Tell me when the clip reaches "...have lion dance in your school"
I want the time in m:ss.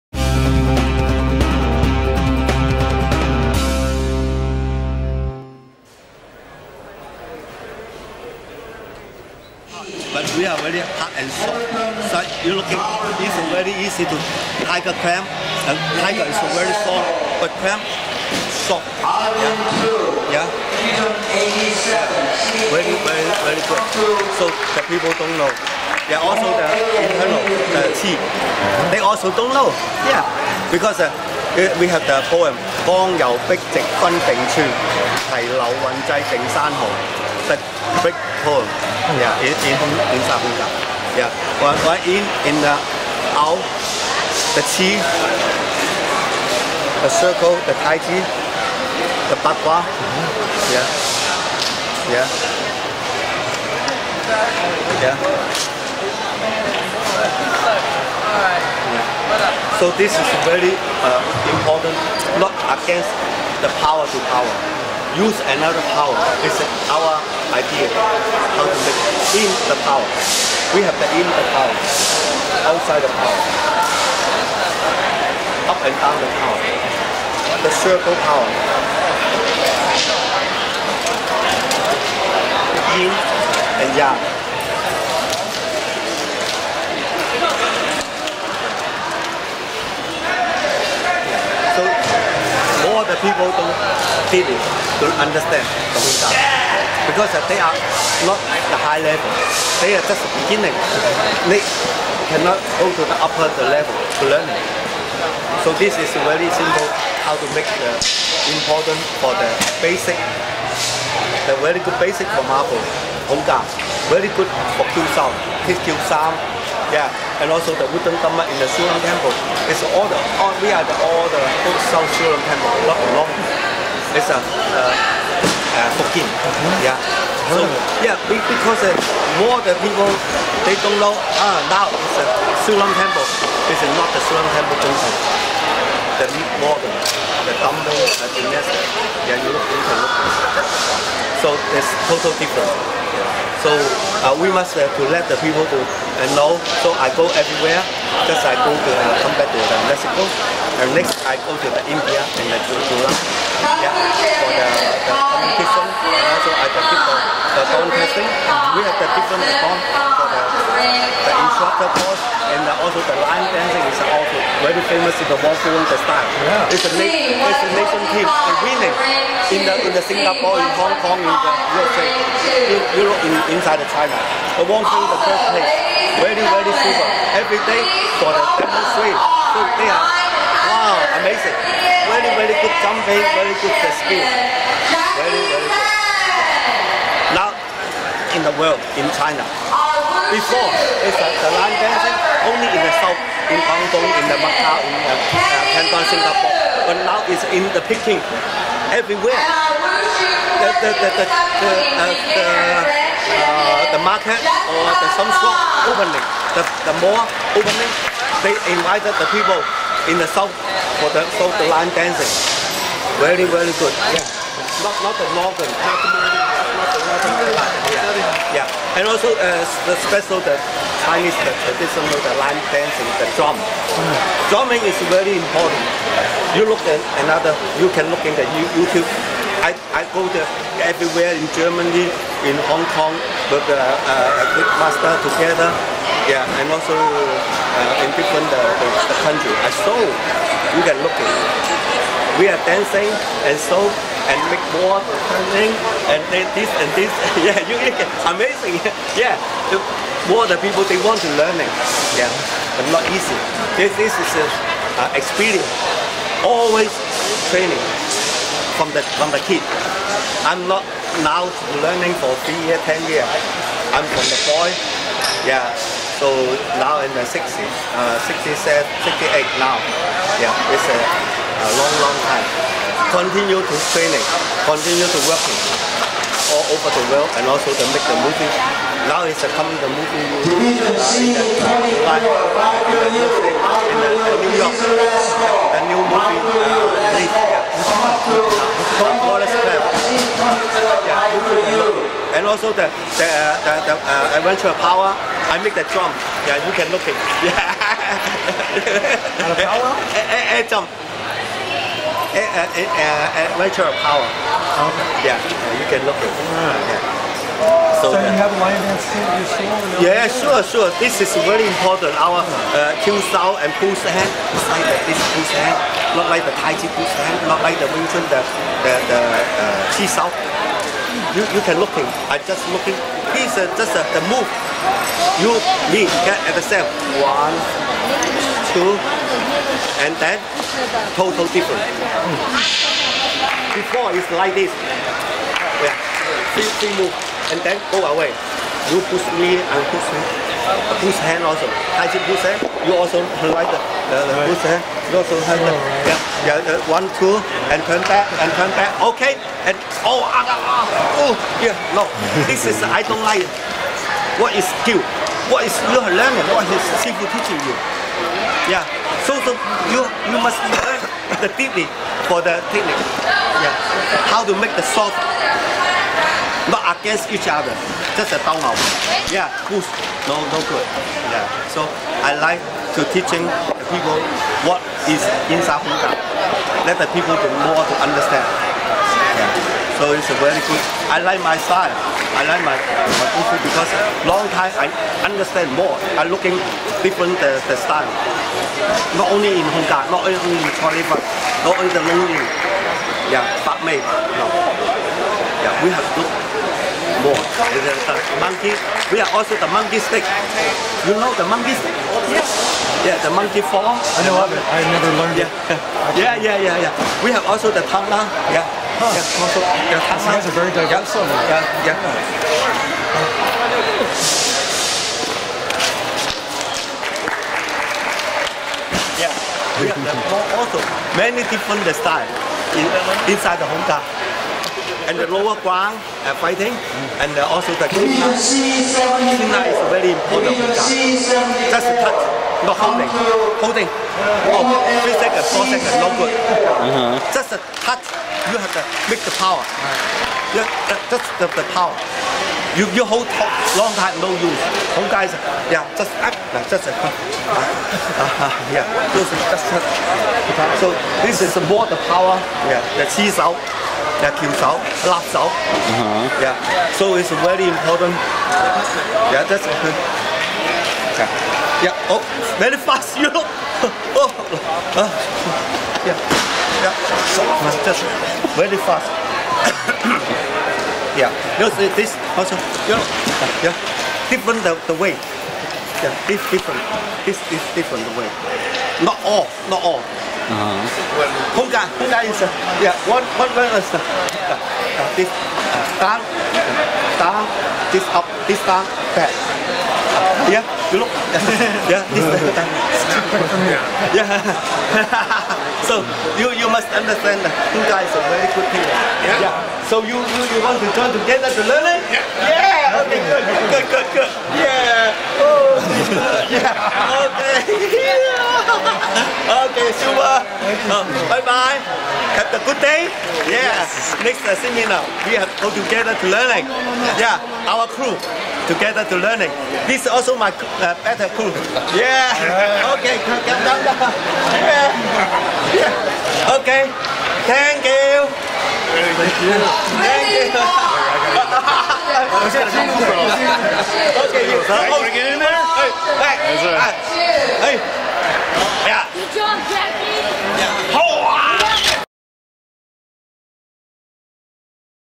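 5:08.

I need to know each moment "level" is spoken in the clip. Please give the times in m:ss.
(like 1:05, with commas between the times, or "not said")
1:39, 1:43.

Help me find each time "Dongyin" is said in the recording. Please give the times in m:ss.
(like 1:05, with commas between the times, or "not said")
1:35.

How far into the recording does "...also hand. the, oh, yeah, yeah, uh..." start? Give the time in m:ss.
5:45.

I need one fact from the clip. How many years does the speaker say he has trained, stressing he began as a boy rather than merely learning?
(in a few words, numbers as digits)
10 years.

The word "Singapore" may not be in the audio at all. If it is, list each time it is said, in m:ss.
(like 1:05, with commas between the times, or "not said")
2:50, 3:16.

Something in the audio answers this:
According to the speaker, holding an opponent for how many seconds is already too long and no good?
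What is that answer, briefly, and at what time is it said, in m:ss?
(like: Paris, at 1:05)
3 seconds, at 7:15.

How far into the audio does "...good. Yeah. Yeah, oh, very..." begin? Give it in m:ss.
7:39.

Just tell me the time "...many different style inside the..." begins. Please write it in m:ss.
7:01.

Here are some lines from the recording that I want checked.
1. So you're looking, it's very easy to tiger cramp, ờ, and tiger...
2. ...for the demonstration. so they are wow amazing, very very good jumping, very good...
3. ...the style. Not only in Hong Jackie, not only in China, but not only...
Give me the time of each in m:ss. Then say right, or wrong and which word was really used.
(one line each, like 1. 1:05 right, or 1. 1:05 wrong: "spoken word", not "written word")
1. 0:12 right
2. 2:58 right
3. 6:27 wrong: "Kong", not "Jackie".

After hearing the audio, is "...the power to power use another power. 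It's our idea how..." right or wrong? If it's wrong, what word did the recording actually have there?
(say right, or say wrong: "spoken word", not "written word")
right.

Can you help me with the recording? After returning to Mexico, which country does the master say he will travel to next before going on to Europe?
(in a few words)
India.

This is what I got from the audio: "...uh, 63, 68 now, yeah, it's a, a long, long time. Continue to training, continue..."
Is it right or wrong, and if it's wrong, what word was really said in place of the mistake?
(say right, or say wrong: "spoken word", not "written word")
wrong: "67", not "63".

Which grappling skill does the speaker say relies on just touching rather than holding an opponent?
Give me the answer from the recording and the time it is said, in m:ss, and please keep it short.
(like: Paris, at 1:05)
qin na, at 7:07.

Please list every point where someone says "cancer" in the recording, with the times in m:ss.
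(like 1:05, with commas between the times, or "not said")
not said.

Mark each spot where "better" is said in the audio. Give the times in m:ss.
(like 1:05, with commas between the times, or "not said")
8:41.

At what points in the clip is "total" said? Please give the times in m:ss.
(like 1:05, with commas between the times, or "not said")
2:22, 5:31.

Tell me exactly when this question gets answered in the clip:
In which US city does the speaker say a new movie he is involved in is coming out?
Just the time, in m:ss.
4:41.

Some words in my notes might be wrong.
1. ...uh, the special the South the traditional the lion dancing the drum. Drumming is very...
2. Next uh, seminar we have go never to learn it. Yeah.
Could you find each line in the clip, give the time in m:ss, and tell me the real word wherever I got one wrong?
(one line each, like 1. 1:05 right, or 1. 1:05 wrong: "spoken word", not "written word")
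1. 3:39 wrong: "Chinese", not "South"
2. 8:34 wrong: "together", not "never".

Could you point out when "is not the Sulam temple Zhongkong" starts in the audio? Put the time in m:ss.
2:13.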